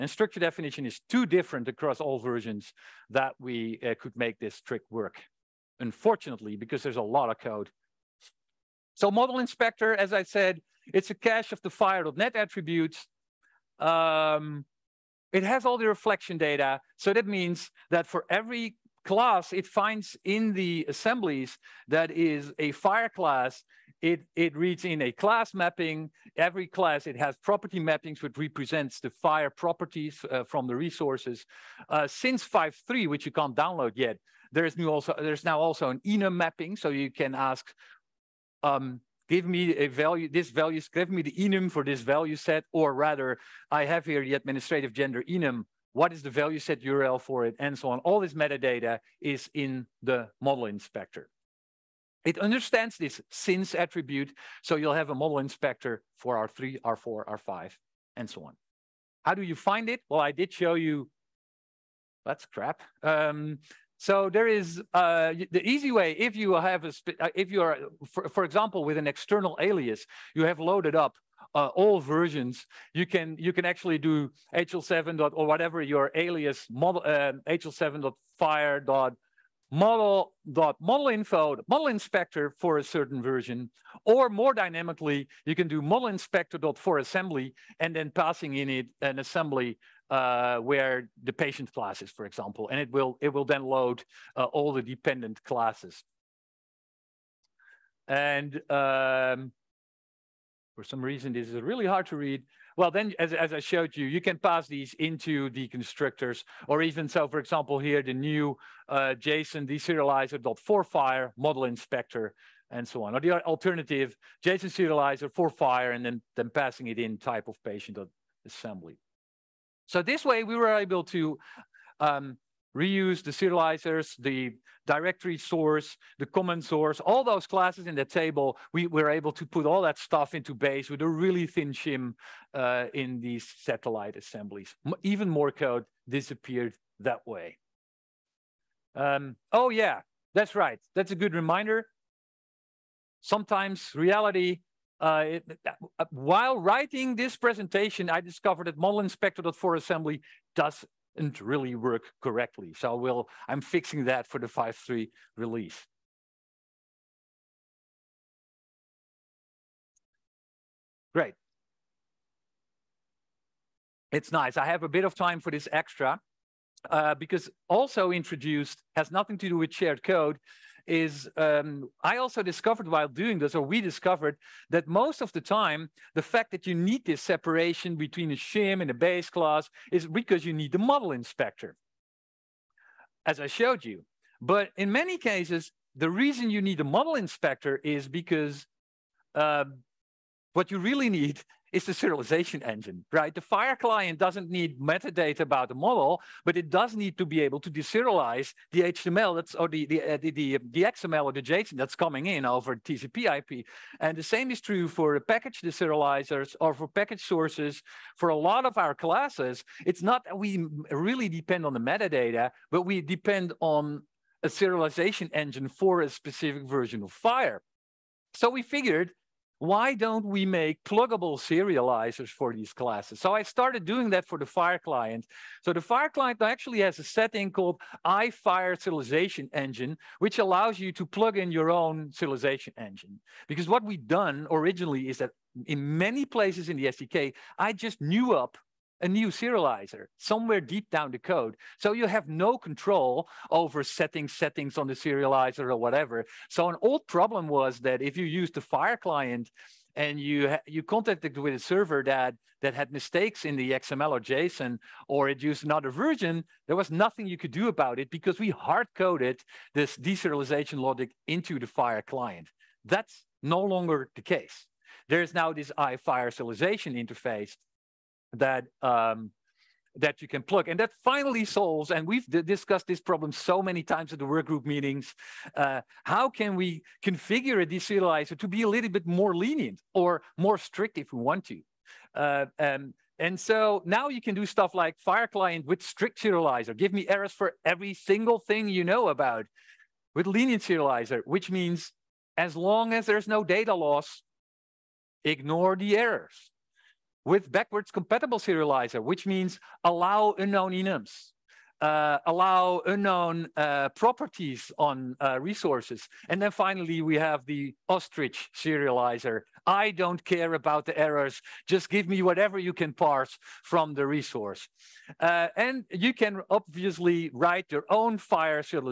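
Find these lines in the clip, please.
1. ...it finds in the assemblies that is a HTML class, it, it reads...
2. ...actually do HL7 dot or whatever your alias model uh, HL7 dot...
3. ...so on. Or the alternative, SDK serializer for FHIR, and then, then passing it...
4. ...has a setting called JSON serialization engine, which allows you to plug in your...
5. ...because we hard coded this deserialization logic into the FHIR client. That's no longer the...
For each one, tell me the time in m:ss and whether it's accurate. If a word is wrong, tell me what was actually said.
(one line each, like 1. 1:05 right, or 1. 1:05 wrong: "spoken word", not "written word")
1. 0:19 wrong: "FHIR", not "HTML"
2. 1:13 right
3. 1:52 wrong: "JSON", not "SDK"
4. 3:46 wrong: "IFhir", not "JSON"
5. 4:18 right.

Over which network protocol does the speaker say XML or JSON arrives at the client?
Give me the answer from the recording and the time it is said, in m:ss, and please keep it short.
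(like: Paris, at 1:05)
TCP/IP, at 3:22.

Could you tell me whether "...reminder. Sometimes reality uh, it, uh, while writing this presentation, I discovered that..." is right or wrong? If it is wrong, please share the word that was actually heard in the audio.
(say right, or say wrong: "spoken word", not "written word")
right.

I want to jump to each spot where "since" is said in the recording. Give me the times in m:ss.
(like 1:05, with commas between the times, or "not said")
0:32, 0:53.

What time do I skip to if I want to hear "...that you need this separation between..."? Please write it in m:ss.
2:56.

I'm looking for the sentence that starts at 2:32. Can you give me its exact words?
So we'll, I'm fixing that for the 5.3 release.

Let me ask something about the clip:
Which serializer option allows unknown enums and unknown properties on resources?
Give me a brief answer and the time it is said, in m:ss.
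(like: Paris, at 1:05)
backwards compatible serializer, at 4:57.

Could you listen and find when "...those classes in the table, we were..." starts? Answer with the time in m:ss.
2:07.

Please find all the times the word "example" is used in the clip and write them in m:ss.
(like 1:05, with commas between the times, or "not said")
1:08, 1:32, 1:47.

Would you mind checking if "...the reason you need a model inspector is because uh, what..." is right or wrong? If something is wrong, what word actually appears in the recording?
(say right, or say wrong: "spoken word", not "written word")
right.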